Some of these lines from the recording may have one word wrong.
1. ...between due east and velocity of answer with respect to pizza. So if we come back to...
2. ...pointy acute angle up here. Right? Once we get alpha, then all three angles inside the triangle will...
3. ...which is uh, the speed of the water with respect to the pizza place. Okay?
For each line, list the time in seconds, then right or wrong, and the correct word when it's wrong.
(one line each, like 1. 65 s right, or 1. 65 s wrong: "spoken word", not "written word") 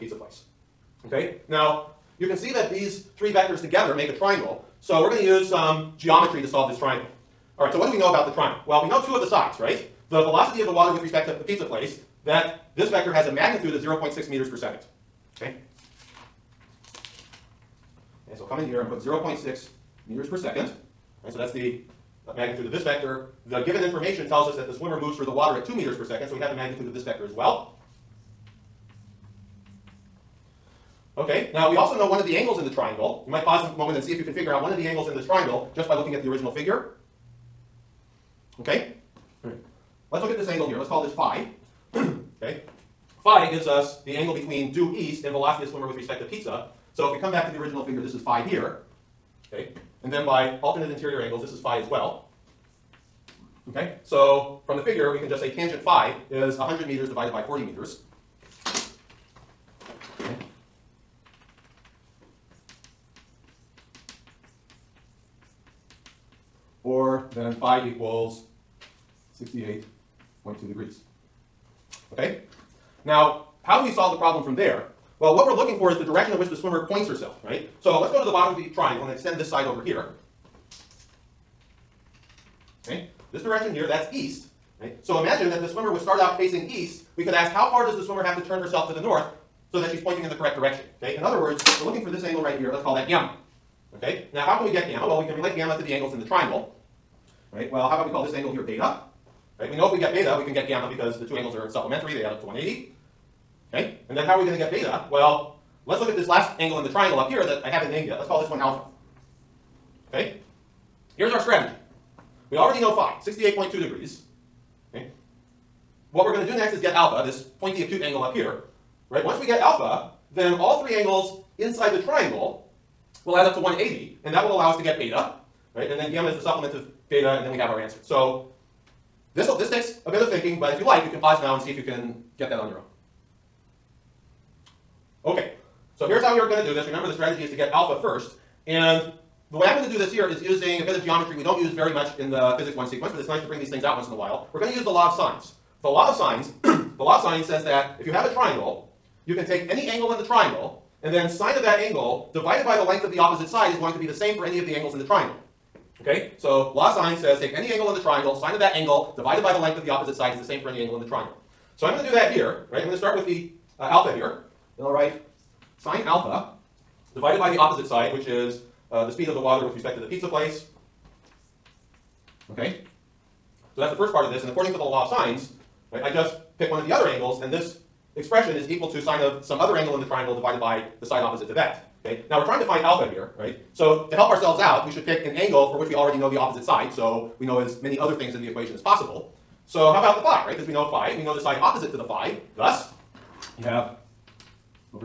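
1. 44 s wrong: "swimmer", not "answer"
2. 117 s right
3. 168 s right.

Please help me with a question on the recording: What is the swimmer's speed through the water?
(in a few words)
2 m/s.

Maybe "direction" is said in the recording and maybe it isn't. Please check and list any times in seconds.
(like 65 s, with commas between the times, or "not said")
76 s, 83 s, 90 s.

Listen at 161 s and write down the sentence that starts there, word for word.
So I'm going to do that here, right?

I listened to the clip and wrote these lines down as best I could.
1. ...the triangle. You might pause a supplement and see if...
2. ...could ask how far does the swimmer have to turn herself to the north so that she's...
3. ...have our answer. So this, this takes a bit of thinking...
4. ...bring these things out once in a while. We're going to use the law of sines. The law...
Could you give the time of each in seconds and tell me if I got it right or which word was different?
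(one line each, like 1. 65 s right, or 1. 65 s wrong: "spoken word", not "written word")
1. 32 s wrong: "moment", not "supplement"
2. 87 s right
3. 127 s right
4. 143 s right.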